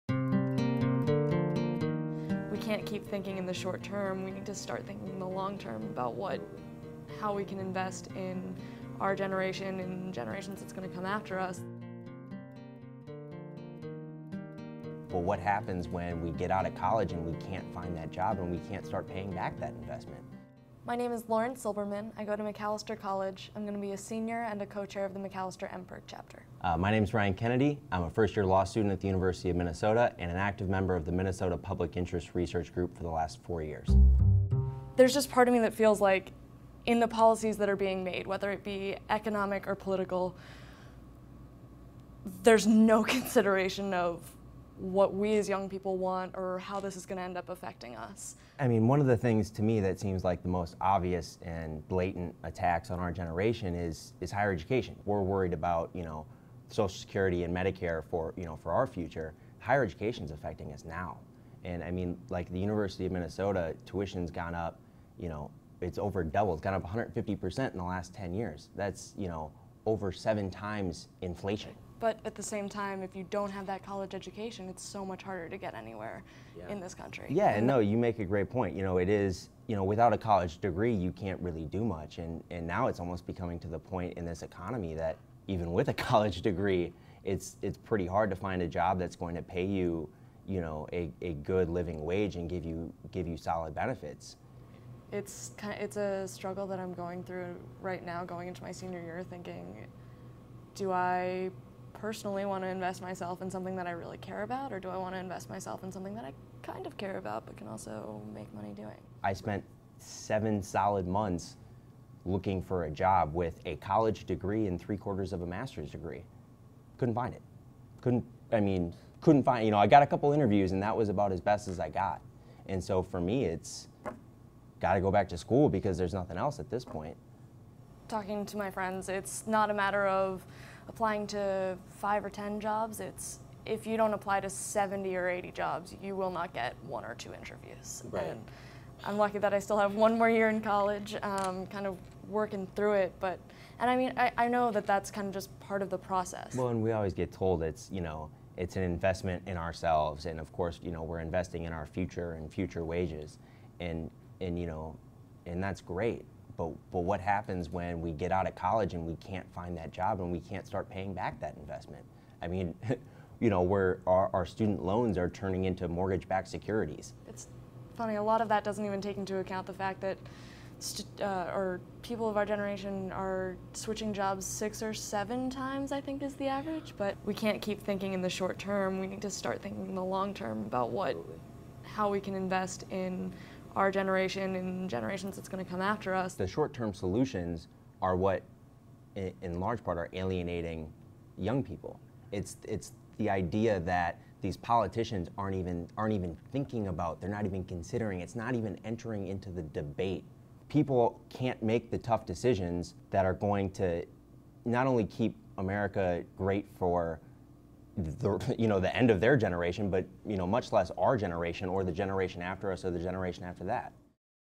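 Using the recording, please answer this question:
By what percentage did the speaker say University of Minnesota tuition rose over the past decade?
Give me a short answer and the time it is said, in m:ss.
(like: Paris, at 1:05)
150%, at 1:06.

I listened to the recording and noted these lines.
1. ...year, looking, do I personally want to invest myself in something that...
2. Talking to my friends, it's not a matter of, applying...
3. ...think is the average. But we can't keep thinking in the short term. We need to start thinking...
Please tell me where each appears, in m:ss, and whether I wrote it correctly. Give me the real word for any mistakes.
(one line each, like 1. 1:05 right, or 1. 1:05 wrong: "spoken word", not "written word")
1. 1:39 wrong: "thinking", not "looking"
2. 2:08 right
3. 2:56 right.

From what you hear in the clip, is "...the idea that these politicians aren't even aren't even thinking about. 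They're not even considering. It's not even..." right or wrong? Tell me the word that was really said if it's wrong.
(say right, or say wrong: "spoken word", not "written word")
right.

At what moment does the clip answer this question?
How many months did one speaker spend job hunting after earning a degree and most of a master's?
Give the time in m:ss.
1:49.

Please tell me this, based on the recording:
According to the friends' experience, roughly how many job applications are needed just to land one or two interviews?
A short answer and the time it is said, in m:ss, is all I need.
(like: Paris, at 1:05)
70 or 80, at 2:14.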